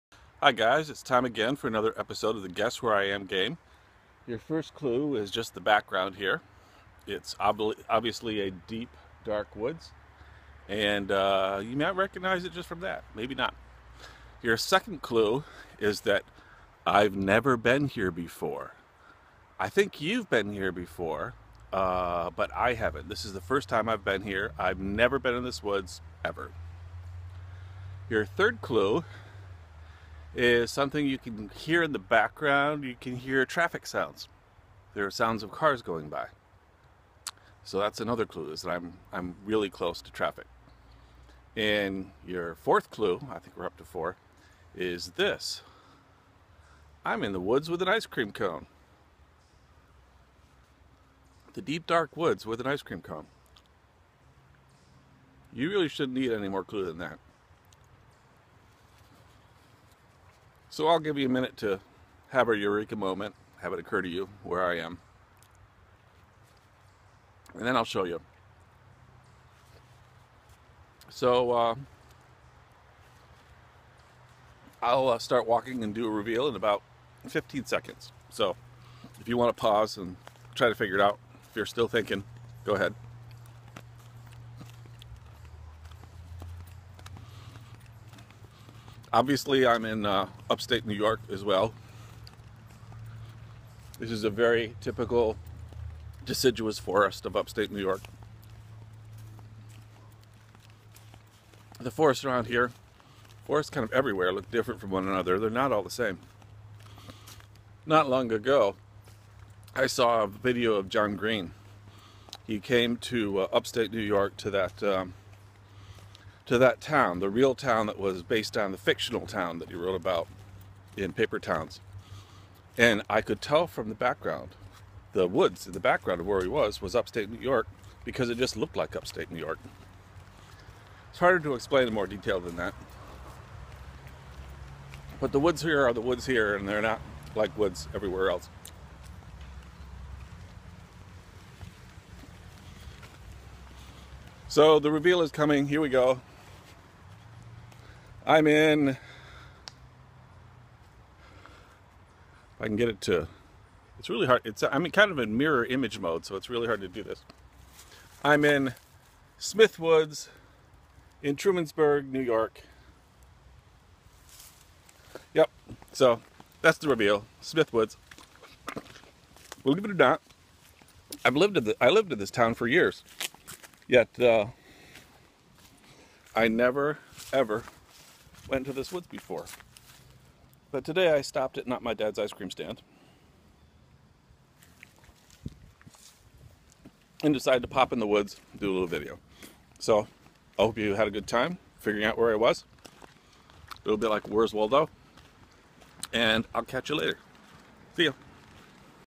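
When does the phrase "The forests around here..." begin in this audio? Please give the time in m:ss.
1:41.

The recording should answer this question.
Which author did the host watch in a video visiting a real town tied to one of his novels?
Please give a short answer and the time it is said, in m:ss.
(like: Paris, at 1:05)
John Green, at 1:50.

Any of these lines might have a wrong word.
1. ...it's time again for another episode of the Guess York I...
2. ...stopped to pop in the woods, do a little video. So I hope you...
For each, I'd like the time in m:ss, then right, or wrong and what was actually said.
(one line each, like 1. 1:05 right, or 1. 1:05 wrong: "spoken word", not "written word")
1. 0:00 wrong: "Where", not "York"
2. 3:07 wrong: "decided", not "stopped".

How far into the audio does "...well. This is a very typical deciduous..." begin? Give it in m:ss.
1:31.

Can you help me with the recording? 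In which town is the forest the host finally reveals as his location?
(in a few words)
Trumansburg, New York.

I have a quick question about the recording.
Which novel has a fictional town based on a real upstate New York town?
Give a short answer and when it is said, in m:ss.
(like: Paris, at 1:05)
Paper Towns, at 2:01.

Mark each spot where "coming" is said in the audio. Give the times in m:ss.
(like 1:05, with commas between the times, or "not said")
2:25.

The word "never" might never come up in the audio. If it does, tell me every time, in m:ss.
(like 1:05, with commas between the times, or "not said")
0:17, 0:24, 2:56.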